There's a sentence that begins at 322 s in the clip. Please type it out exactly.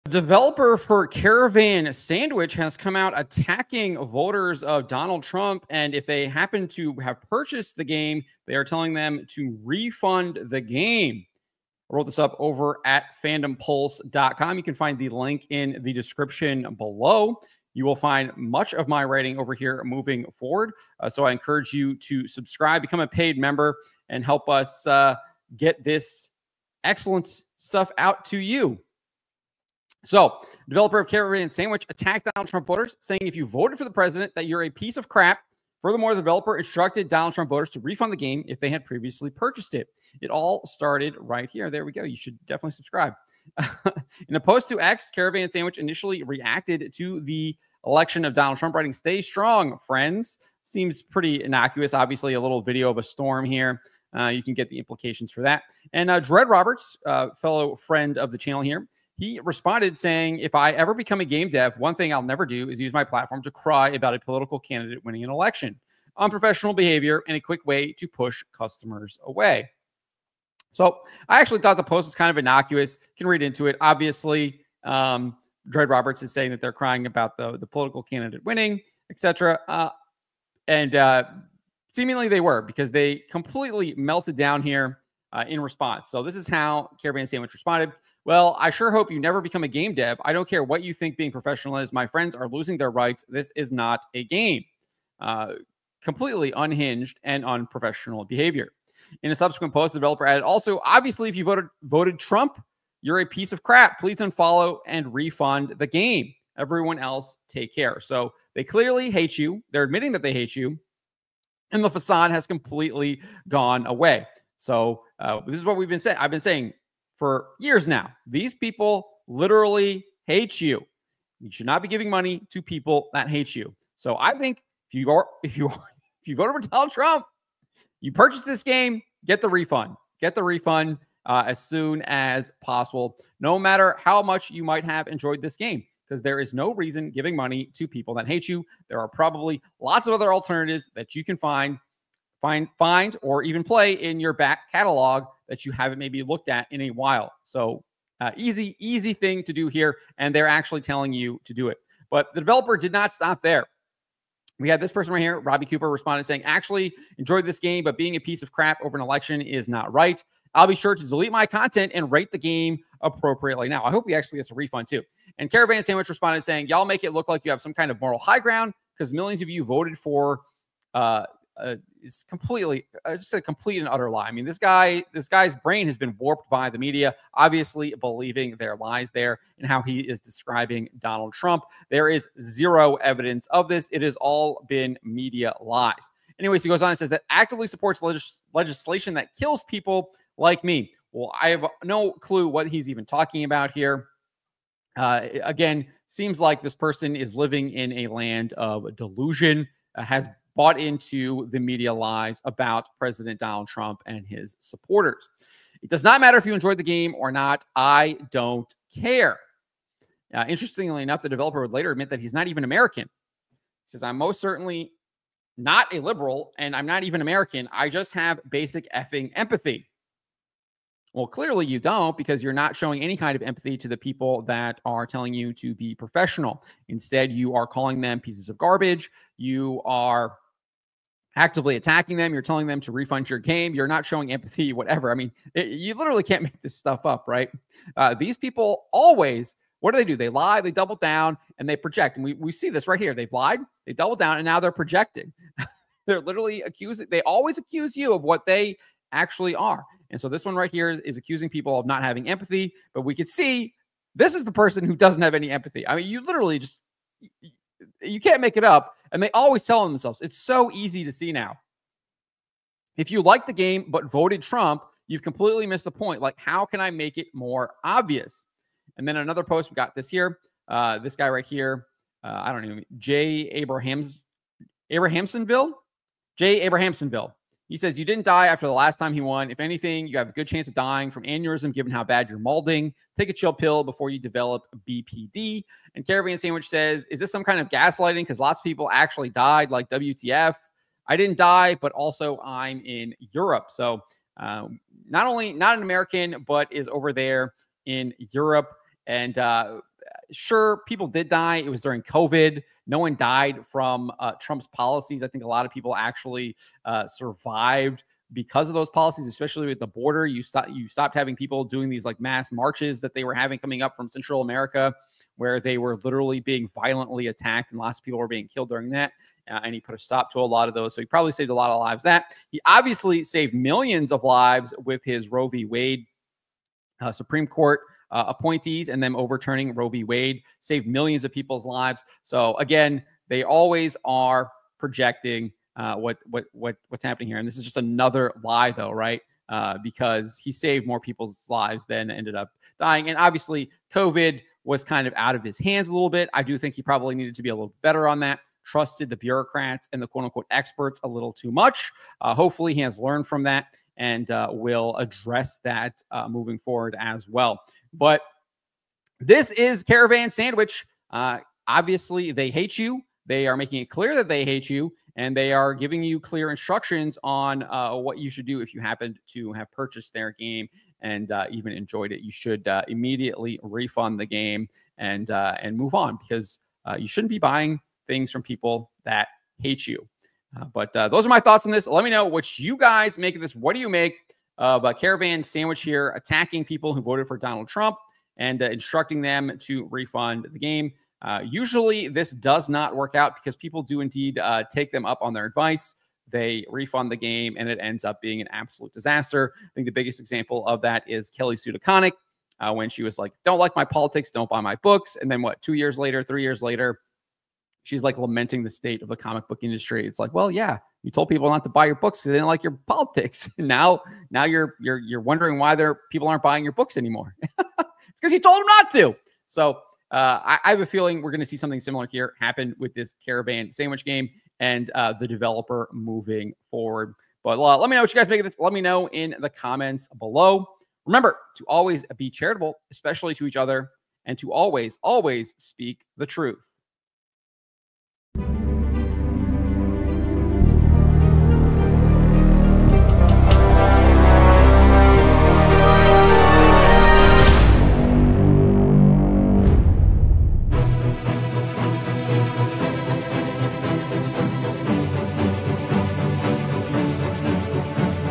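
That he obviously saved millions of lives with his Roe v.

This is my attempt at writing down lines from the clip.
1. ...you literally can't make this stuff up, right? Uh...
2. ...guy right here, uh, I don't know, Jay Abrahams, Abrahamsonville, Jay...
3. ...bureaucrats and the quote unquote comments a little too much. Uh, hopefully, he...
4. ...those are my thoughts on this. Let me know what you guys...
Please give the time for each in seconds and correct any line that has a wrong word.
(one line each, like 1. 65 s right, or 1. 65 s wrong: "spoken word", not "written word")
1. 235 s right
2. 271 s right
3. 349 s wrong: "experts", not "comments"
4. 381 s right.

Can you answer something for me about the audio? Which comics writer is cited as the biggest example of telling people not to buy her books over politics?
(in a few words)
Kelly Sue DeConnick.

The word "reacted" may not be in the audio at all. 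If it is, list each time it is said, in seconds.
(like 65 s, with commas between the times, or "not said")
46 s.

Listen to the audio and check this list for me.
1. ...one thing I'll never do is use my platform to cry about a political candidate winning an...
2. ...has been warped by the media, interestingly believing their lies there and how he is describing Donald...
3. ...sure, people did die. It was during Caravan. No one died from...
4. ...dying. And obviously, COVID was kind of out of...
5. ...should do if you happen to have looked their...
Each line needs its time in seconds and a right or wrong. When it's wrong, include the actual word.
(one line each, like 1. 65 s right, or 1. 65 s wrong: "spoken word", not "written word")
1. 61 s right
2. 175 s wrong: "obviously", not "interestingly"
3. 300 s wrong: "COVID", not "Caravan"
4. 342 s right
5. 368 s wrong: "purchased", not "looked".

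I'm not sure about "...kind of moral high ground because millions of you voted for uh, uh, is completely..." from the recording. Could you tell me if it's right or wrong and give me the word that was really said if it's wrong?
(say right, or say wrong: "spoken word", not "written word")
right.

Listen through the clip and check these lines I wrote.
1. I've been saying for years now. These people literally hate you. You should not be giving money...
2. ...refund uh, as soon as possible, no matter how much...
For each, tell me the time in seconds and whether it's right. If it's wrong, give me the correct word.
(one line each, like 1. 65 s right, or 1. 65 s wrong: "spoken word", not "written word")
1. 116 s right
2. 130 s right.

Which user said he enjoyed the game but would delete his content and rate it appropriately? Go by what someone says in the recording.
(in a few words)
Robbie Cooper.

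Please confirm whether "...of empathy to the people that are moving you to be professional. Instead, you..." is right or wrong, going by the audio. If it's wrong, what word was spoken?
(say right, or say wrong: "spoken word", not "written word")
wrong: "telling", not "moving".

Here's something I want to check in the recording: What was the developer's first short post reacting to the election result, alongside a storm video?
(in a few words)
Stay strong, friends.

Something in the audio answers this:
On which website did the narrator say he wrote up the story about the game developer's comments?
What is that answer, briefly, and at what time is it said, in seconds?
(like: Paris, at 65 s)
fandompulse.com, at 13 s.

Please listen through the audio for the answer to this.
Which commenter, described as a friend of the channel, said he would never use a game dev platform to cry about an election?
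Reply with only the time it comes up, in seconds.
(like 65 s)
56 s.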